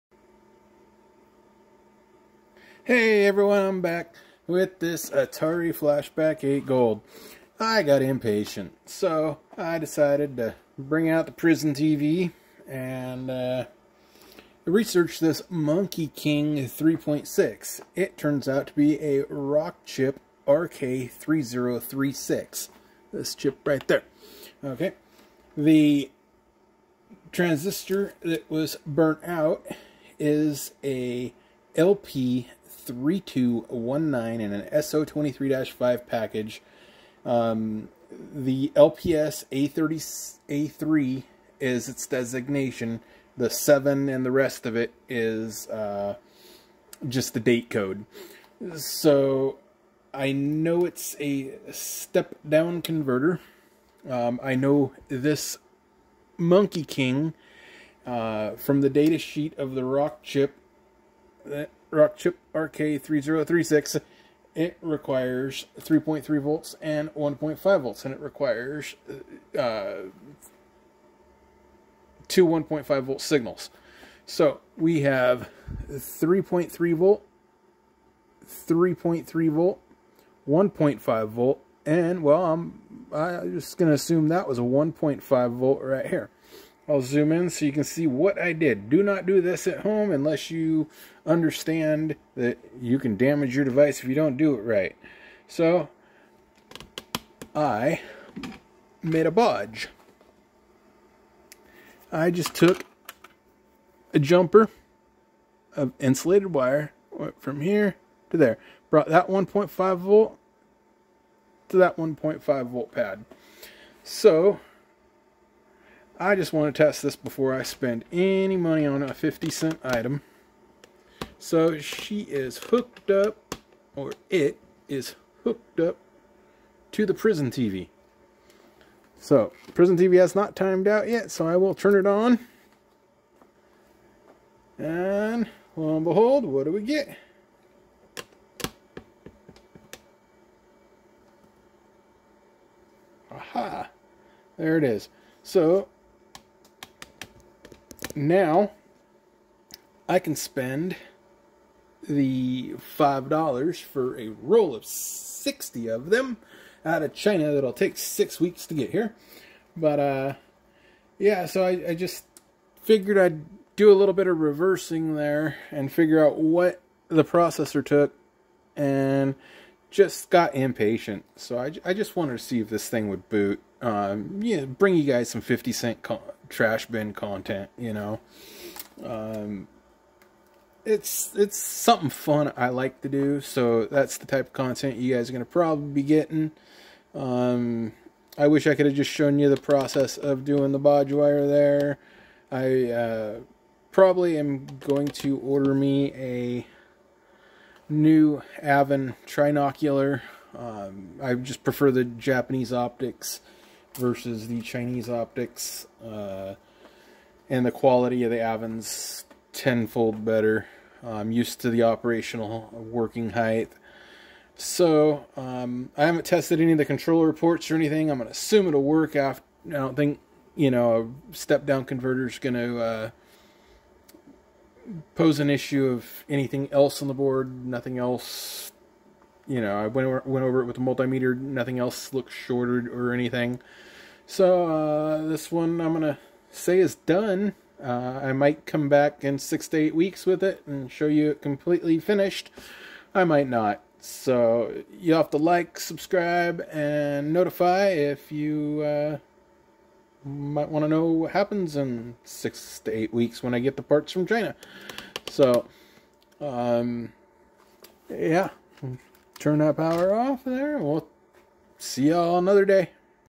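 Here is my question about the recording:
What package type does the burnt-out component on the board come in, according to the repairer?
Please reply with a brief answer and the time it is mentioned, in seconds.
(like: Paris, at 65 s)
SO23-5, at 34 s.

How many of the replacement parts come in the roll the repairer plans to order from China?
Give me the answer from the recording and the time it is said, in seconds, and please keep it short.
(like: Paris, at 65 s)
60, at 154 s.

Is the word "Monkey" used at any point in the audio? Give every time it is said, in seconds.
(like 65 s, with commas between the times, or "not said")
15 s, 56 s.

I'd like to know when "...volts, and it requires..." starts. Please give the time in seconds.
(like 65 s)
67 s.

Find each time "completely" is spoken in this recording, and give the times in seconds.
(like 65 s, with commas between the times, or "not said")
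241 s.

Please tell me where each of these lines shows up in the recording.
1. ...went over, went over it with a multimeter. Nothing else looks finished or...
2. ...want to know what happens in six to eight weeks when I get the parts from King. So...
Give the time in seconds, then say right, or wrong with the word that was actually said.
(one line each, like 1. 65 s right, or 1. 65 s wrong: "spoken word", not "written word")
1. 229 s wrong: "shorted", not "finished"
2. 250 s wrong: "China", not "King".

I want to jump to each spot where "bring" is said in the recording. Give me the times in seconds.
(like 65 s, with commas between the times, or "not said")
10 s, 174 s.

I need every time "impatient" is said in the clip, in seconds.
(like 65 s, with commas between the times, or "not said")
8 s, 170 s.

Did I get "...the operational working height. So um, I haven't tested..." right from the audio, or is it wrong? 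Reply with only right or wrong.
right.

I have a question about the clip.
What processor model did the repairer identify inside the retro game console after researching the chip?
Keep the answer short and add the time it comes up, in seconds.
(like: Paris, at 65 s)
Rockchip RK3036, at 19 s.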